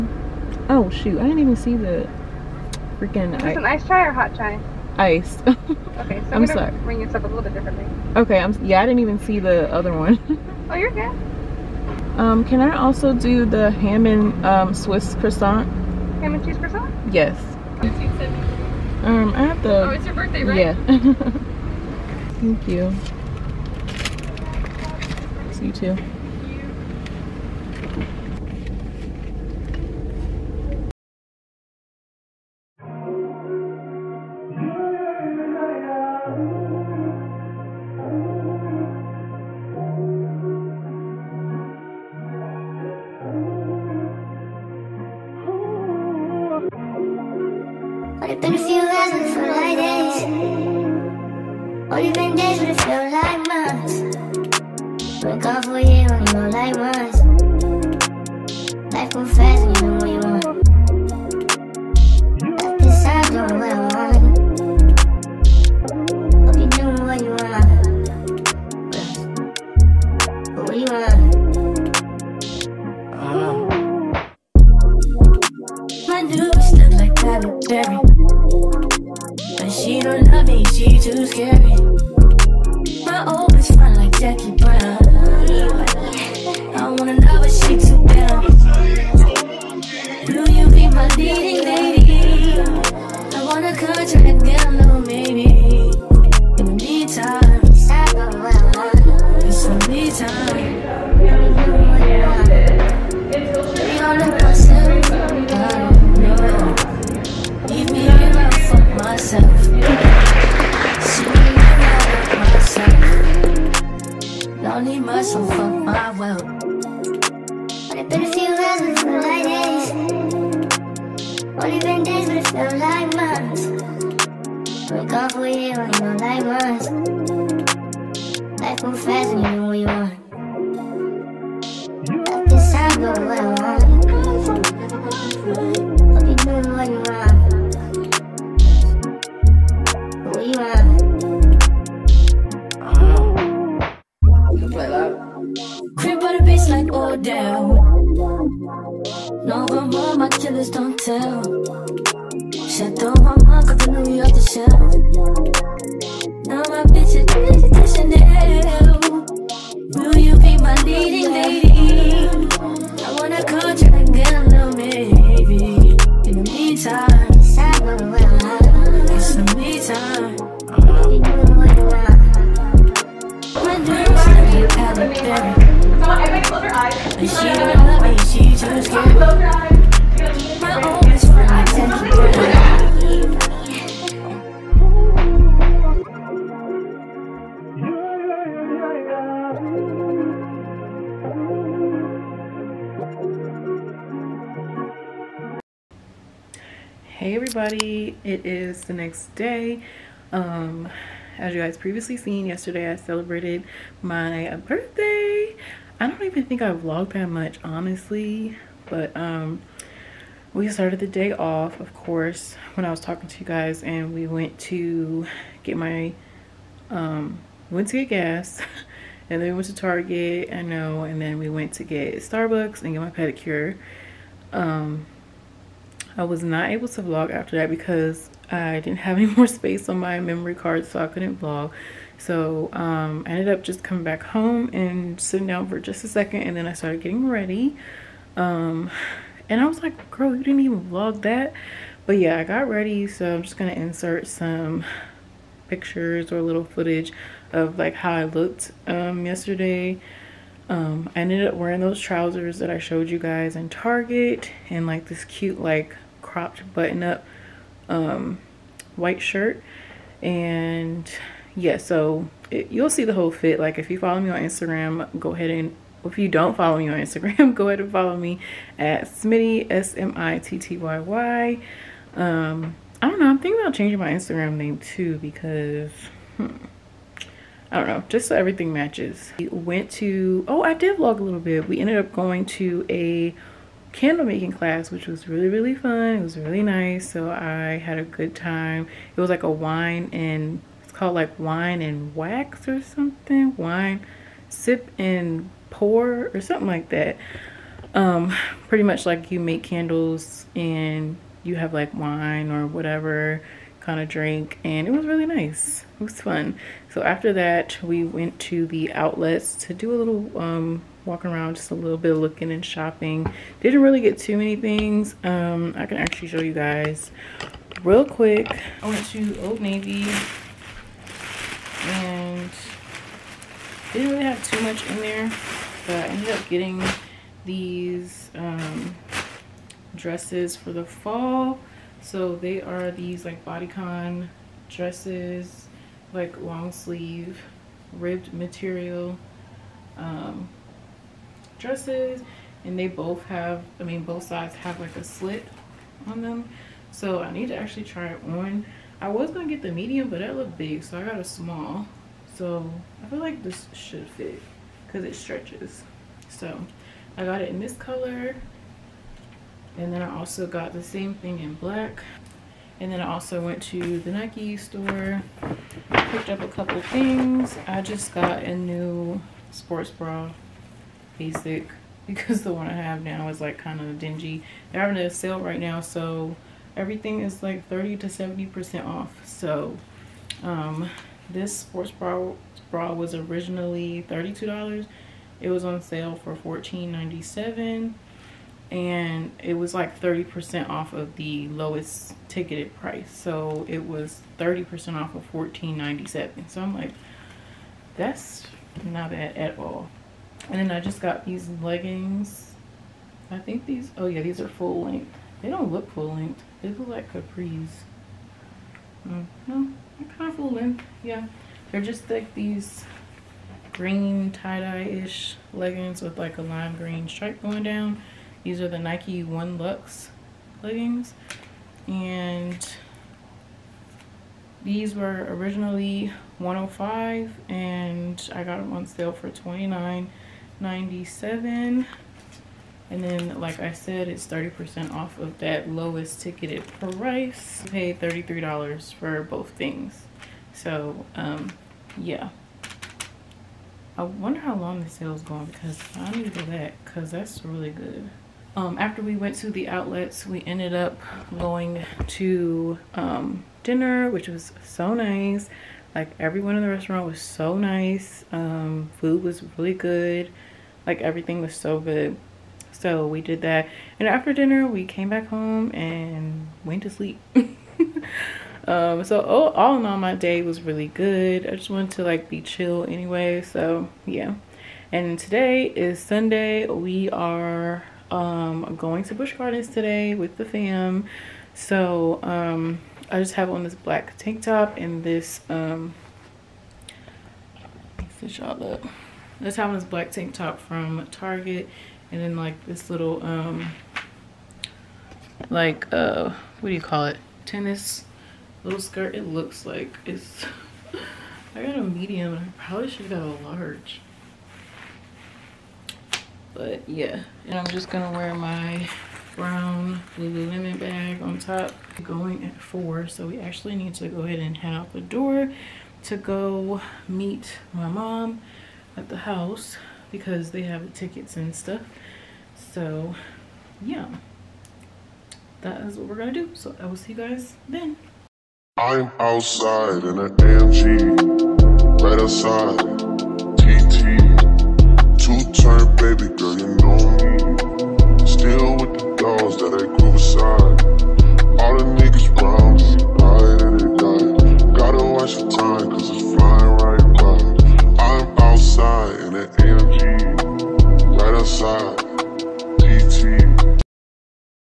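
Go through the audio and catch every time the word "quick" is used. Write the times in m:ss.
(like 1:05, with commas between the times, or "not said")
5:18.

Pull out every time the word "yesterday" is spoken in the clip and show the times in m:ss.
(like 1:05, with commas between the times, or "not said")
3:22, 4:09.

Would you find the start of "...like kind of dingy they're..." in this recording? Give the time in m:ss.
6:13.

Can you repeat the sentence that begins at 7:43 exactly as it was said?
And after dinner, we came back home and went to sleep.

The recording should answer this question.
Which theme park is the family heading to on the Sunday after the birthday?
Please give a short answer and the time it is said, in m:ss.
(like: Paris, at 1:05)
Busch Gardens, at 7:59.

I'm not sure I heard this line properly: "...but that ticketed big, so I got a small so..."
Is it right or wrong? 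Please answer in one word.
wrong.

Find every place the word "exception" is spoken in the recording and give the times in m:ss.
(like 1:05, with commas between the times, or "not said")
not said.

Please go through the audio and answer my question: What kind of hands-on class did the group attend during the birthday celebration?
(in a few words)
candle making class.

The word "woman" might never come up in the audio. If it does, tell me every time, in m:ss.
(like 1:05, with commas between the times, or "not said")
not said.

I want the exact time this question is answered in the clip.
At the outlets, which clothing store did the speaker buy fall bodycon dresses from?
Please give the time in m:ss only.
5:19.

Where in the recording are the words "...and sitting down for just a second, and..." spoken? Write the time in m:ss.
3:54.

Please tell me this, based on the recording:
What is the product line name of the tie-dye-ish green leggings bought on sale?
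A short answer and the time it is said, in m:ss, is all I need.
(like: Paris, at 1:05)
Nike One Luxe, at 6:58.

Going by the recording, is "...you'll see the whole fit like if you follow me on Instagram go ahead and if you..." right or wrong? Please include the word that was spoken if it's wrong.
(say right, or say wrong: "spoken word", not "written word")
right.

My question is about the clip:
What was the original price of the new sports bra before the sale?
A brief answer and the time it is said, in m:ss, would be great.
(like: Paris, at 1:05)
$32, at 6:24.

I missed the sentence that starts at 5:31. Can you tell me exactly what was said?
So they are these like bodycon dresses, like long sleeve, ribbed material um, dresses.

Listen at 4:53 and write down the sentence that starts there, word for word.
Wine, sip and pour or something like that.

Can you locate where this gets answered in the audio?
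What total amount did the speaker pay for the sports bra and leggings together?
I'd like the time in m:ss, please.
7:17.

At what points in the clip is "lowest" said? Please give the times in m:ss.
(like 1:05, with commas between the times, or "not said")
6:31, 7:15.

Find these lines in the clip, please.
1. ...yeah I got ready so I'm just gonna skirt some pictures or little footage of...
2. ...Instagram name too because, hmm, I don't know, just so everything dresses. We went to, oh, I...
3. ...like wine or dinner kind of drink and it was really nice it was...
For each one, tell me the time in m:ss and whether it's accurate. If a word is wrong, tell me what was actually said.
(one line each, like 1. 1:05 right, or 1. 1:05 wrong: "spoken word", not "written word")
1. 4:02 wrong: "insert", not "skirt"
2. 4:34 wrong: "matches", not "dresses"
3. 5:01 wrong: "whatever", not "dinner".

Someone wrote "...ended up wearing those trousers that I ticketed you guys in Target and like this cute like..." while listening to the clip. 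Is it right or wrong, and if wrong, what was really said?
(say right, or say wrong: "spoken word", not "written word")
wrong: "showed", not "ticketed".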